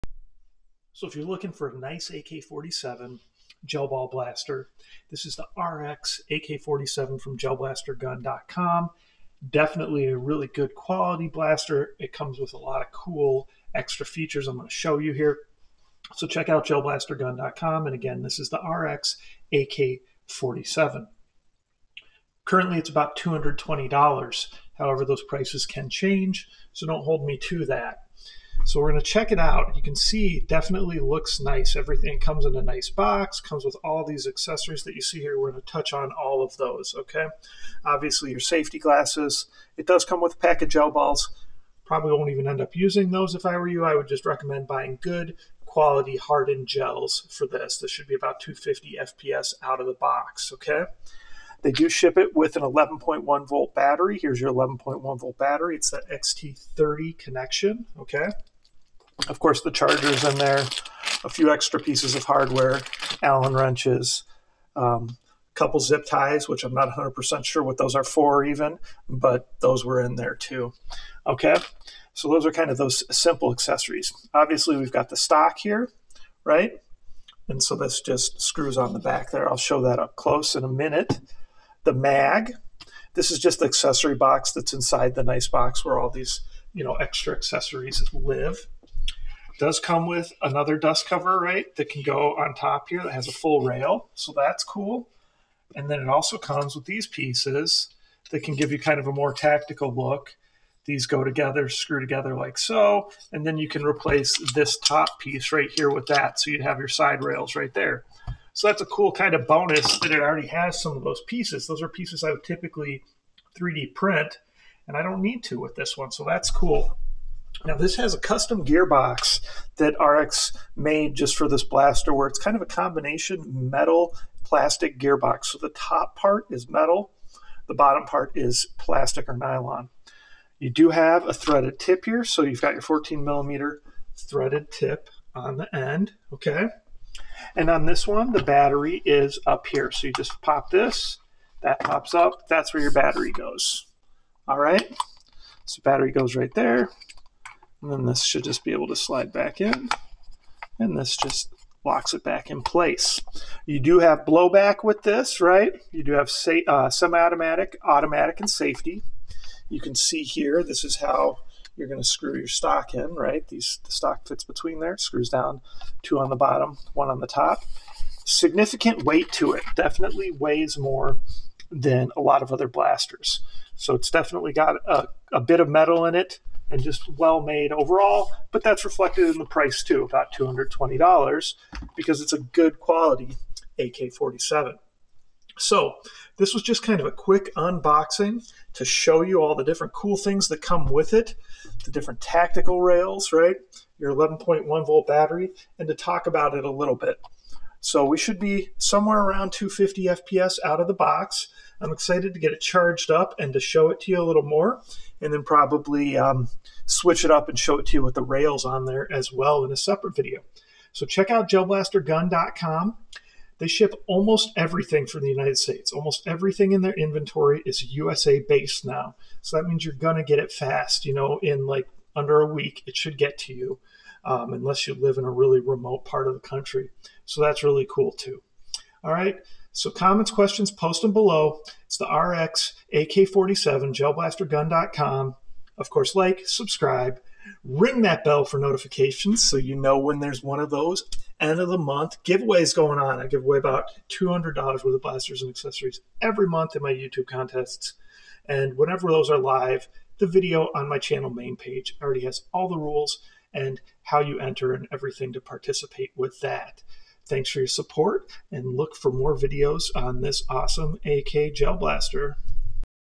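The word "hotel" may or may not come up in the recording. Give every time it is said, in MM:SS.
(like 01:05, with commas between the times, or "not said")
not said.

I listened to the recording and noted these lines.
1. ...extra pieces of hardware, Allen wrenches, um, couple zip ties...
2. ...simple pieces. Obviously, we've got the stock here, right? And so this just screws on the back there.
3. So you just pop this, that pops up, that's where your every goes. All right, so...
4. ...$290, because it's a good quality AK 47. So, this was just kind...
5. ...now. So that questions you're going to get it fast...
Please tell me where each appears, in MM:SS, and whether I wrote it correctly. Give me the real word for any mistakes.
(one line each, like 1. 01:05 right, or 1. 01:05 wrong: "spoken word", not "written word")
1. 01:01 right
2. 01:13 wrong: "accessories", not "pieces"
3. 02:19 wrong: "battery", not "every"
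4. 03:00 wrong: "220", not "290"
5. 03:38 wrong: "means", not "questions".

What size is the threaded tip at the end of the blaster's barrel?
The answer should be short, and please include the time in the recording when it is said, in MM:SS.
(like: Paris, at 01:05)
14 millimeter, at 02:12.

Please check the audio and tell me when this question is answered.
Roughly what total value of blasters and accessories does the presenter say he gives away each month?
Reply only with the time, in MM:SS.
04:04.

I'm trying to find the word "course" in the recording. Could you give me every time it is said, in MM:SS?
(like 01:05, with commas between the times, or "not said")
00:59, 03:55.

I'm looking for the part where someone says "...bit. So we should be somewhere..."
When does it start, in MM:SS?
03:16.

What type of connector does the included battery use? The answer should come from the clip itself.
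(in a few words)
XT30.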